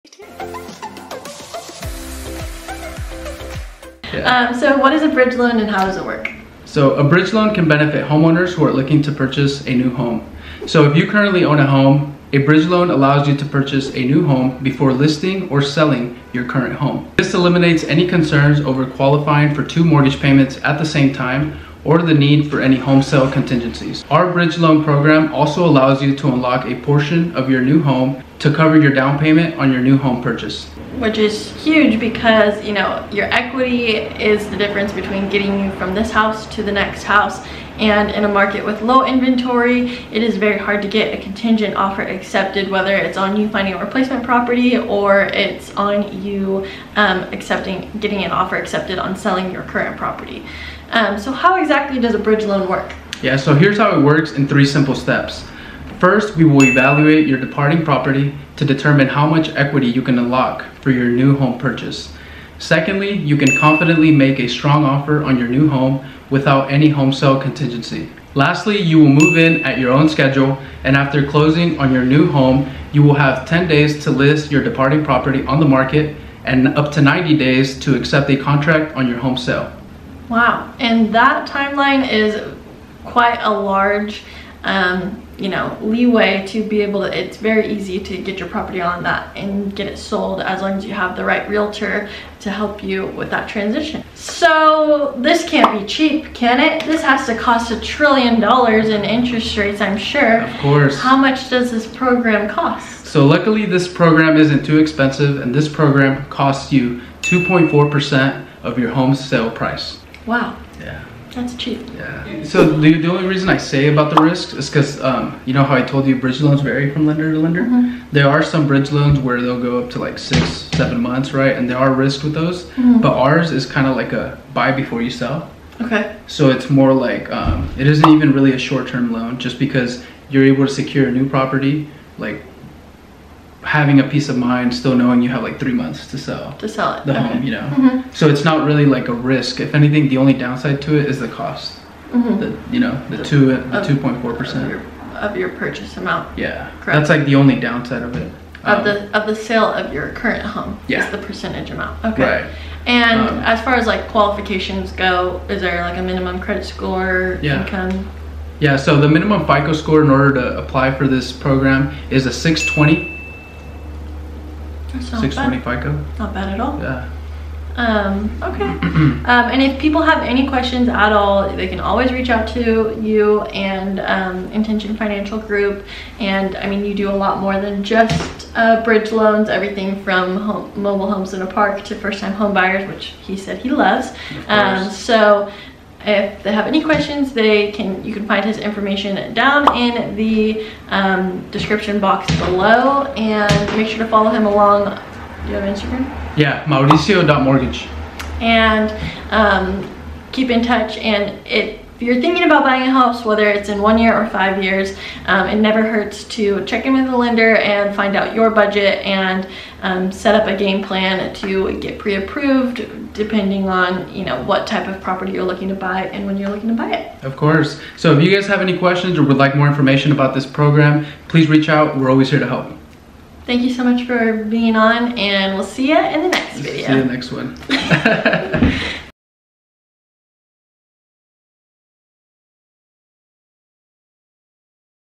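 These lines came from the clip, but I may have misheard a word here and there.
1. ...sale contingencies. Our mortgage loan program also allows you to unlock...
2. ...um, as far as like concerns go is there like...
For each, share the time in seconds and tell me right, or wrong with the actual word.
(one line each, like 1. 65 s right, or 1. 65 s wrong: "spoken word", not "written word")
1. 23 s wrong: "bridge", not "mortgage"
2. 153 s wrong: "qualifications", not "concerns".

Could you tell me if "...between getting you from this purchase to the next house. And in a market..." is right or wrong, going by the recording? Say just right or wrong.
wrong.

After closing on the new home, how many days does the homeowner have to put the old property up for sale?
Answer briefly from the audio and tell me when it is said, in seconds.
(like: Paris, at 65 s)
10 days, at 73 s.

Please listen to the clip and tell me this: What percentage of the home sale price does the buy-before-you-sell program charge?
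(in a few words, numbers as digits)
2.4%.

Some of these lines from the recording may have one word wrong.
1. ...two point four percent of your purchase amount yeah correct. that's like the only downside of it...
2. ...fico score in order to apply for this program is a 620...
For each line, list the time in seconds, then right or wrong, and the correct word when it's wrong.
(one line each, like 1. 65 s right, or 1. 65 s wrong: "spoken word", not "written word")
1. 143 s right
2. 159 s right.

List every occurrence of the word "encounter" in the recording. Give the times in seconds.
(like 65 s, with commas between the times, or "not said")
not said.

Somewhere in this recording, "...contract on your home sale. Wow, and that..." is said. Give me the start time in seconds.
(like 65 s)
78 s.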